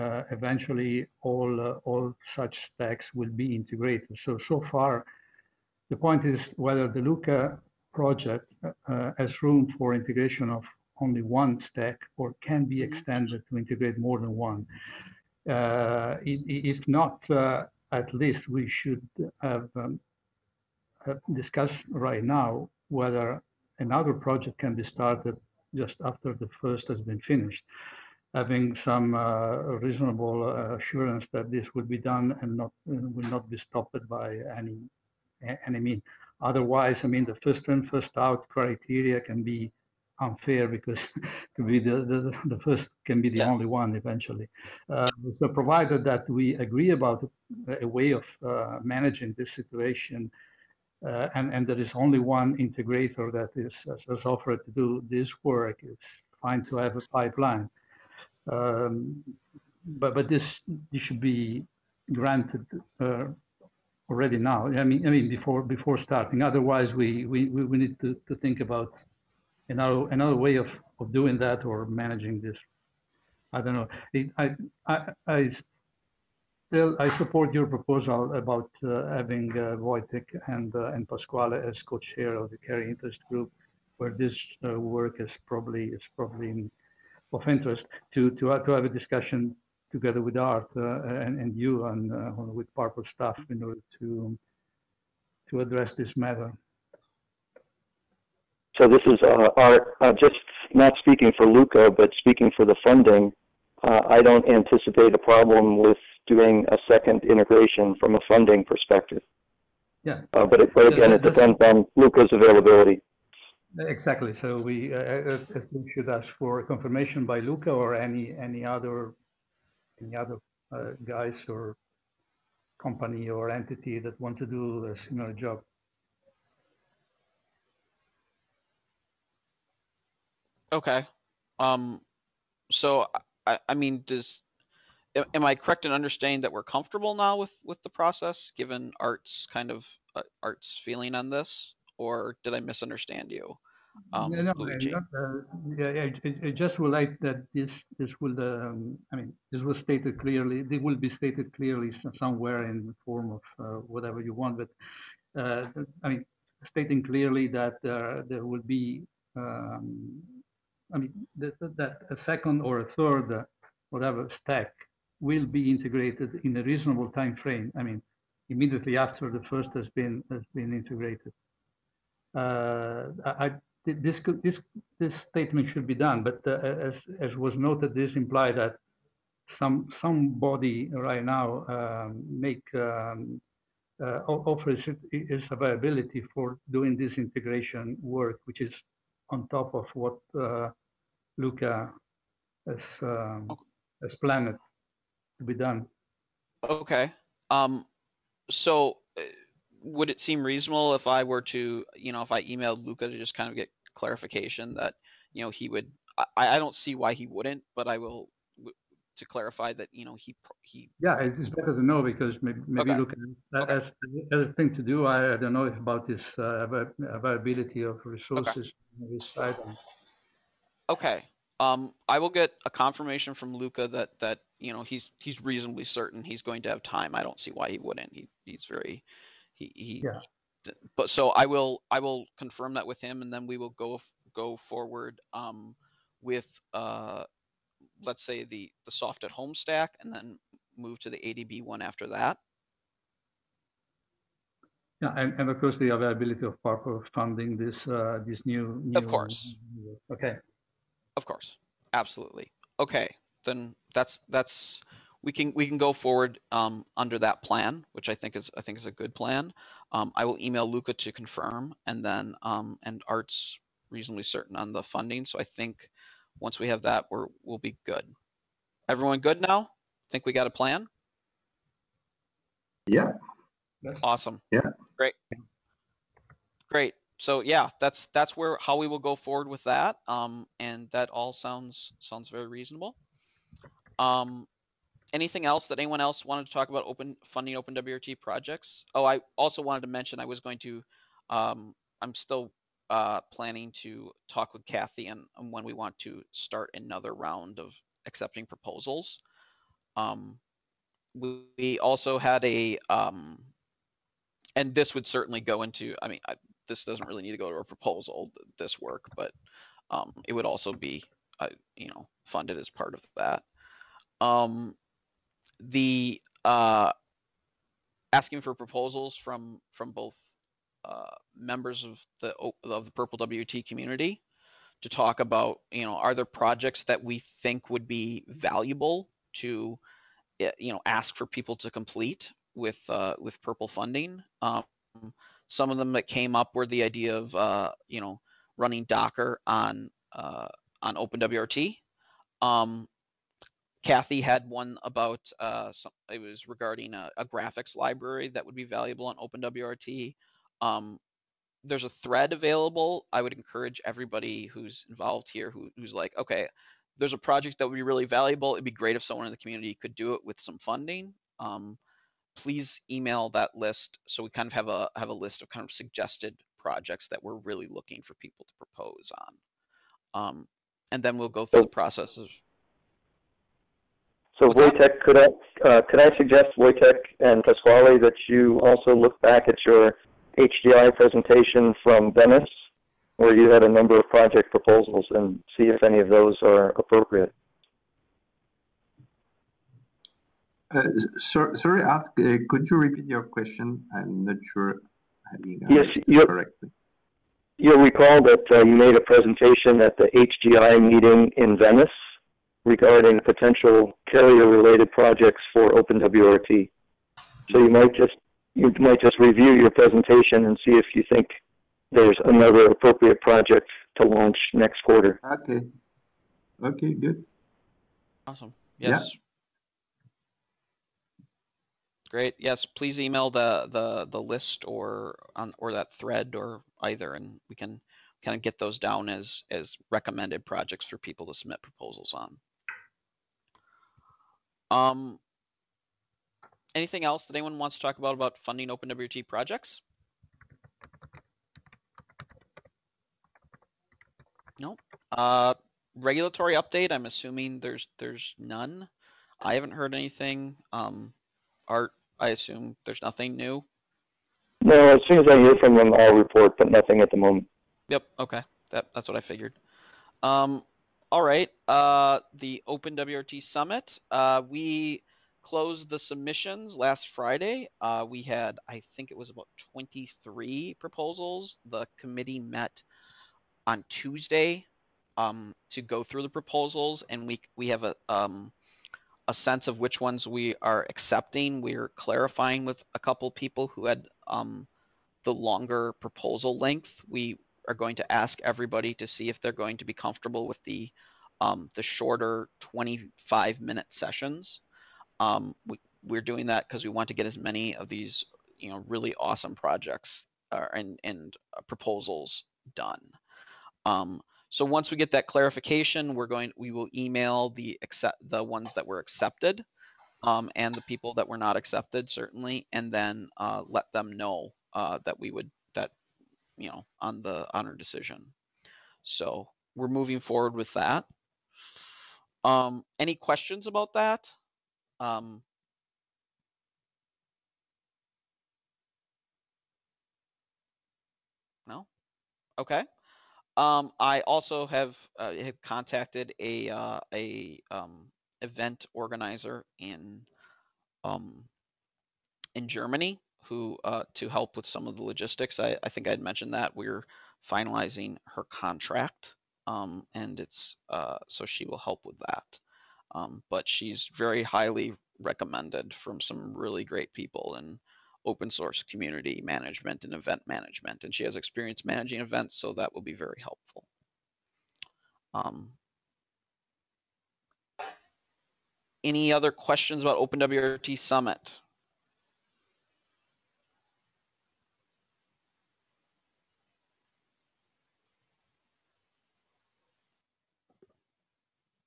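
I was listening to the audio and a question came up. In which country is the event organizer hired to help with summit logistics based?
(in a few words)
Germany.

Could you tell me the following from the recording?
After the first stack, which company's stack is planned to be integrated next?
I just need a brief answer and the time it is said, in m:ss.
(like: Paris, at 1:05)
ADB, at 4:01.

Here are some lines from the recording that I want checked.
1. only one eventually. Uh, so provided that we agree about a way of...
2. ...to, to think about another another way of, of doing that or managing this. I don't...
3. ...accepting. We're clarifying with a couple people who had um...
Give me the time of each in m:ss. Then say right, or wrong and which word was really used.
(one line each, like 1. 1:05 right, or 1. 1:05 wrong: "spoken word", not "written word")
1. 0:43 right
2. 1:07 right
3. 8:00 right.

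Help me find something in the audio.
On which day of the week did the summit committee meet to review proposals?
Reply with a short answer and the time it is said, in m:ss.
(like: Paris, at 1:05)
Tuesday, at 7:53.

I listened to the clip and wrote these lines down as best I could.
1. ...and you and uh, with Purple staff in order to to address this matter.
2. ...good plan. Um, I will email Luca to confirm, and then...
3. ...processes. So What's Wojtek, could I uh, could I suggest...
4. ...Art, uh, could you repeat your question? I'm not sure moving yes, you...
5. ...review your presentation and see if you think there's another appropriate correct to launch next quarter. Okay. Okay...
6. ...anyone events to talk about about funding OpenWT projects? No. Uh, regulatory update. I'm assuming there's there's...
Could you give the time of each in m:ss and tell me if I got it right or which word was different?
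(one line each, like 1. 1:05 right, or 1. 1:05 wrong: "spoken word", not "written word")
1. 1:31 right
2. 4:18 right
3. 6:11 right
4. 6:31 wrong: "having", not "moving"
5. 6:49 wrong: "project", not "correct"
6. 7:17 wrong: "wants", not "events".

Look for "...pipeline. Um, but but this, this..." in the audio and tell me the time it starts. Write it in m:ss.
0:57.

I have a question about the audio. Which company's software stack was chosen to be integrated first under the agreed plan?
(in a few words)
SoftAtHome.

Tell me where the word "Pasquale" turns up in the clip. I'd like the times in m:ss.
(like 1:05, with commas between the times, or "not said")
1:21, 6:17.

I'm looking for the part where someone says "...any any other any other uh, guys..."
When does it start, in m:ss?
1:57.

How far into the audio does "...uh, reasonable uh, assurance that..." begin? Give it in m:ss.
0:29.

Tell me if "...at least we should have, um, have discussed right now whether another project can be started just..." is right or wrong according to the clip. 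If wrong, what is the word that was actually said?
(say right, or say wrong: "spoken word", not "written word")
right.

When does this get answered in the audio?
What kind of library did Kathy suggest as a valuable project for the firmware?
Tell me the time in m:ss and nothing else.
5:47.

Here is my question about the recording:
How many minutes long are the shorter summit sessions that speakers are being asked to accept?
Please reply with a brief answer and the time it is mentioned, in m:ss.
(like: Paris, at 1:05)
25, at 8:12.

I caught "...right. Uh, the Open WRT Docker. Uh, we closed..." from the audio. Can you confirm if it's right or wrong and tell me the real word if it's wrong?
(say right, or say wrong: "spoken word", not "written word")
wrong: "Summit", not "Docker".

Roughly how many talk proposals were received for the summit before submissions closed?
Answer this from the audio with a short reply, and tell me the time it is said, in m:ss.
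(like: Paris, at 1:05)
23, at 7:49.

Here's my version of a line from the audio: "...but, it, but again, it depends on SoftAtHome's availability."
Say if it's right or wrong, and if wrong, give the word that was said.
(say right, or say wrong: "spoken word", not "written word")
wrong: "Luca", not "SoftAtHome".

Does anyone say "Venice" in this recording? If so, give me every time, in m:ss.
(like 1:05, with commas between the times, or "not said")
6:22, 6:41.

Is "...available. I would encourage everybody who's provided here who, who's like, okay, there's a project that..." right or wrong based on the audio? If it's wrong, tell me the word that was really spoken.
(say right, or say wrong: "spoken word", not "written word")
wrong: "involved", not "provided".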